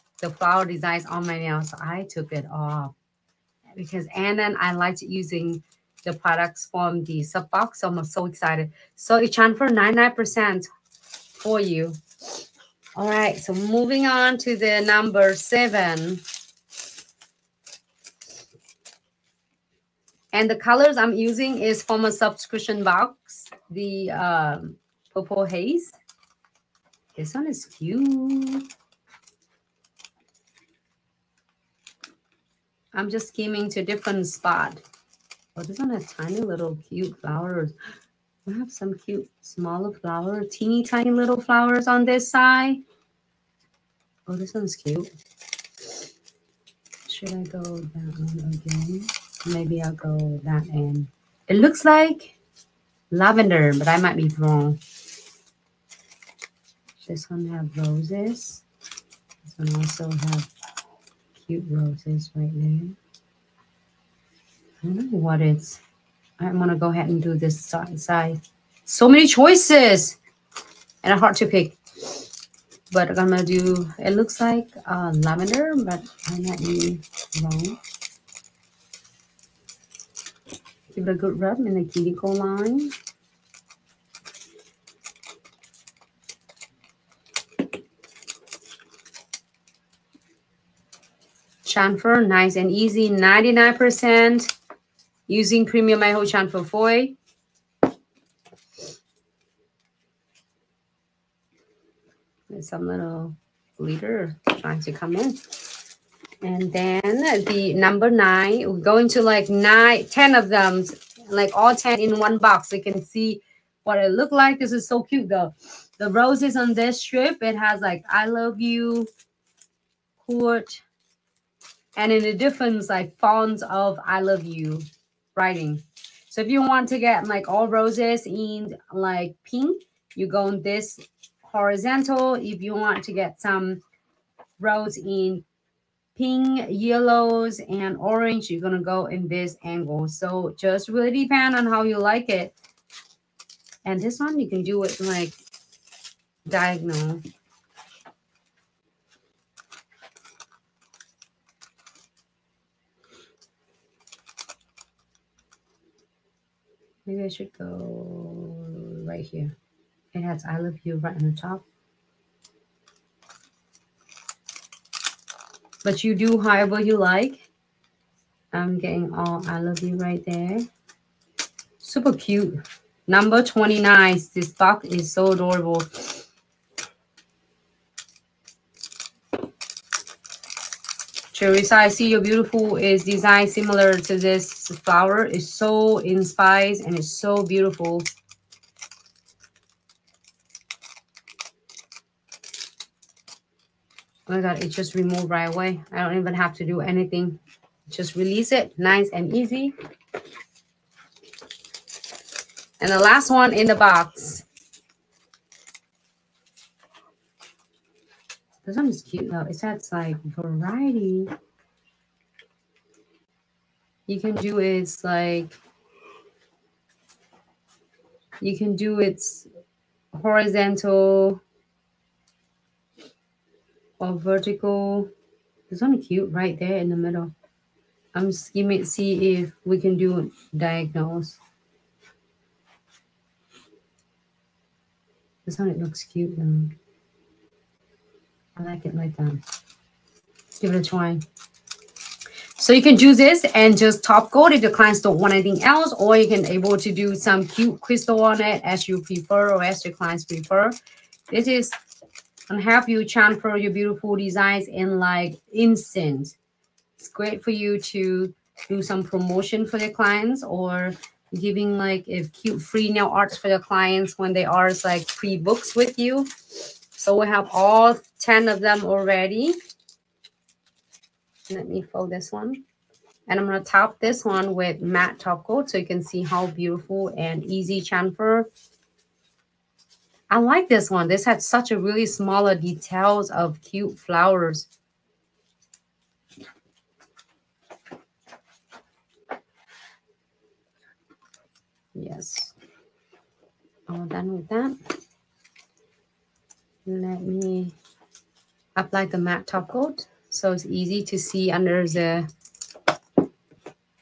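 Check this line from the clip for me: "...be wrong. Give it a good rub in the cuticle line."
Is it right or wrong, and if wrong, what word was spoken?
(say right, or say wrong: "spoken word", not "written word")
right.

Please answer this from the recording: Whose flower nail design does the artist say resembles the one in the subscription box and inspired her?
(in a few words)
Teresa.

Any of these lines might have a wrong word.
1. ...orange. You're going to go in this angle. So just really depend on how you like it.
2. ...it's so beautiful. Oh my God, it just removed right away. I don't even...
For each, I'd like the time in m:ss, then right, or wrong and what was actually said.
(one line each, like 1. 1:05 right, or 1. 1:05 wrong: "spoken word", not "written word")
1. 2:17 right
2. 3:06 right.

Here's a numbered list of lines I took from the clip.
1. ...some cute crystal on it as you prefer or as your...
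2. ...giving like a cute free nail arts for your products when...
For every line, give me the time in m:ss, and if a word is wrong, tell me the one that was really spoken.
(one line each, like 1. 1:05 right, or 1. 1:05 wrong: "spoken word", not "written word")
1. 4:07 right
2. 4:21 wrong: "clients", not "products".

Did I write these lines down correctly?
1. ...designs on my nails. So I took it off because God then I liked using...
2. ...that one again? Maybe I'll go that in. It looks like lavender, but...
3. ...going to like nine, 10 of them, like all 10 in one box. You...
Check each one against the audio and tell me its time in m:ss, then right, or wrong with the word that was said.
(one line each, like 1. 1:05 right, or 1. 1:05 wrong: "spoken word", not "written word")
1. 0:00 wrong: "Anna", not "God"
2. 0:47 right
3. 1:48 right.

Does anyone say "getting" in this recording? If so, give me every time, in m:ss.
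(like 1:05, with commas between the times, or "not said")
2:48.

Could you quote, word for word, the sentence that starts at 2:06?
So if you want to get like all roses in like pink, you go on this horizontal.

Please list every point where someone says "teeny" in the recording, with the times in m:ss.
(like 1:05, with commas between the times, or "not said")
0:40.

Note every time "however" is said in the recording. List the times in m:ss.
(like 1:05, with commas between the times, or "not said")
2:46.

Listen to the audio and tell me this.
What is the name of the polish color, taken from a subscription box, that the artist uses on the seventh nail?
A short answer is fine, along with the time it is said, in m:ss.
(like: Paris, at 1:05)
Purple Haze, at 0:25.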